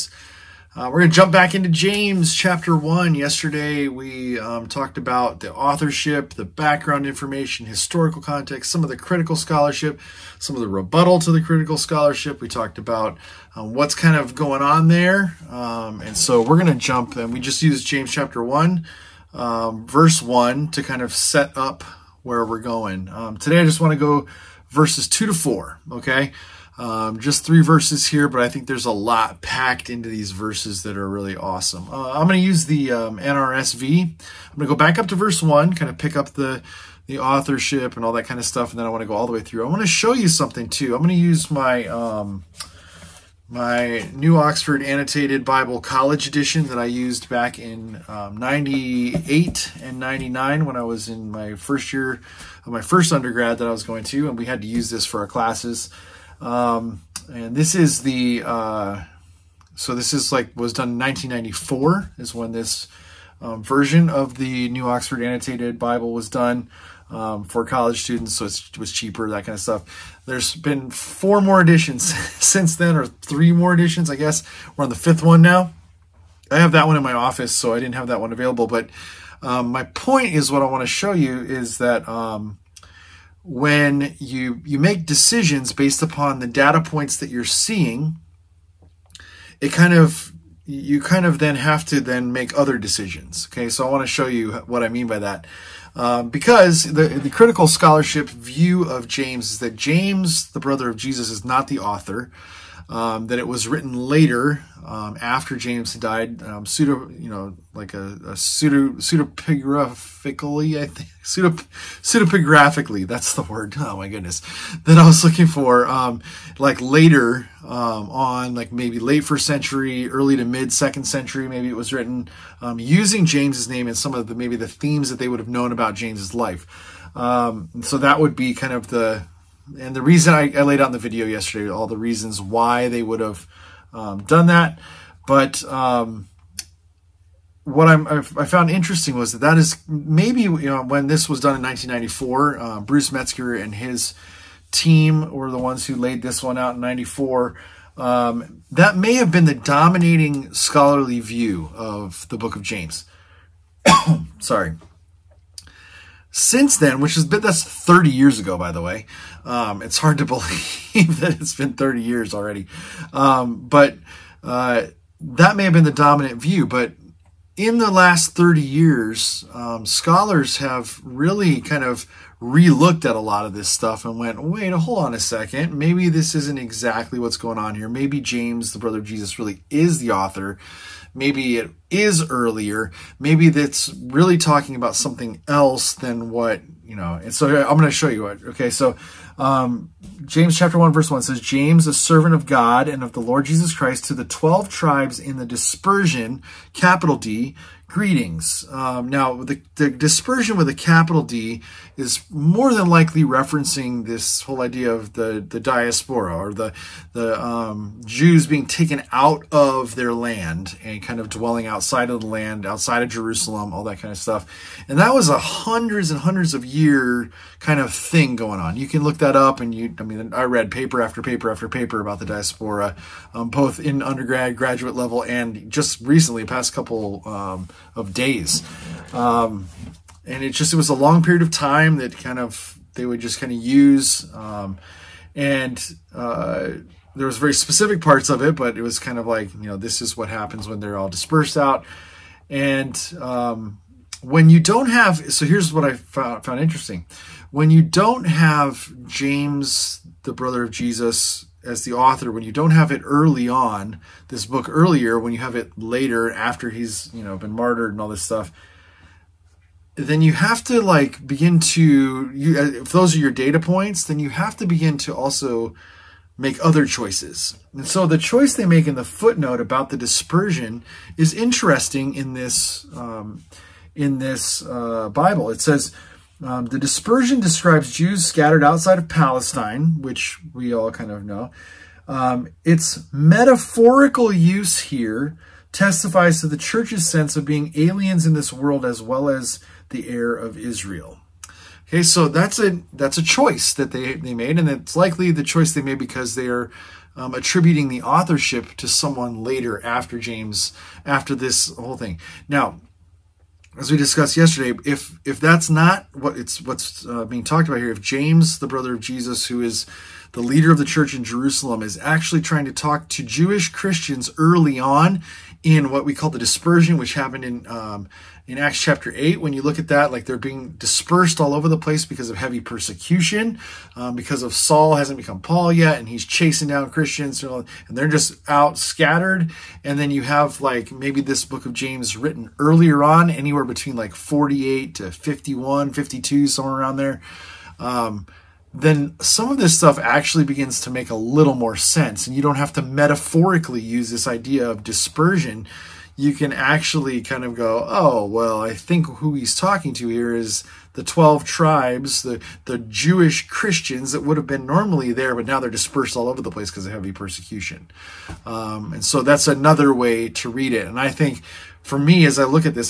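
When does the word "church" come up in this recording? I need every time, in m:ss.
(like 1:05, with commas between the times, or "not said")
4:46, 5:10.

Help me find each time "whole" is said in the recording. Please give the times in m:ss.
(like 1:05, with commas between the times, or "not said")
3:24, 5:01.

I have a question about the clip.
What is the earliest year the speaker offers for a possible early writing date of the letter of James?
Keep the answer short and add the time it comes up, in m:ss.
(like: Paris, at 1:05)
48, at 5:34.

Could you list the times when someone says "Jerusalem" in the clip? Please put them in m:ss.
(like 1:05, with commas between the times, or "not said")
3:33, 5:11.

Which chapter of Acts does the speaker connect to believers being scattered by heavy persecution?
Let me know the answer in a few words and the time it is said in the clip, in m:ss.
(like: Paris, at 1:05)
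Acts chapter 8, at 5:18.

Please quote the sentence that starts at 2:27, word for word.
Um, that may have been the dominating scholarly view of the book of James.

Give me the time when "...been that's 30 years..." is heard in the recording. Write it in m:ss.
2:37.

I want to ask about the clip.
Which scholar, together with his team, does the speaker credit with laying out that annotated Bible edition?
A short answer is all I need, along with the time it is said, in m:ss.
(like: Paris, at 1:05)
Bruce Metzger, at 2:22.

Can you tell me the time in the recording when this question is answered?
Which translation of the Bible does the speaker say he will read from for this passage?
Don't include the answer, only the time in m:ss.
0:33.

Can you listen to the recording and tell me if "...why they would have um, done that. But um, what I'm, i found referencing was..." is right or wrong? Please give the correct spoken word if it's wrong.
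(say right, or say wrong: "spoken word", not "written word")
wrong: "interesting", not "referencing".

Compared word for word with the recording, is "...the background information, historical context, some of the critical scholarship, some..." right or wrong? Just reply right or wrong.
right.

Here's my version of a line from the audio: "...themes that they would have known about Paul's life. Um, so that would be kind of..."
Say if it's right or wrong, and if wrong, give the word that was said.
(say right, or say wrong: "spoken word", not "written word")
wrong: "James", not "Paul".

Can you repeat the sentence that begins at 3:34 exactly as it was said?
And that was a hundreds and hundreds of year kind of thing going on.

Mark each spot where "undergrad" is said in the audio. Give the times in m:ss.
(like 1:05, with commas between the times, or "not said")
0:53, 3:44.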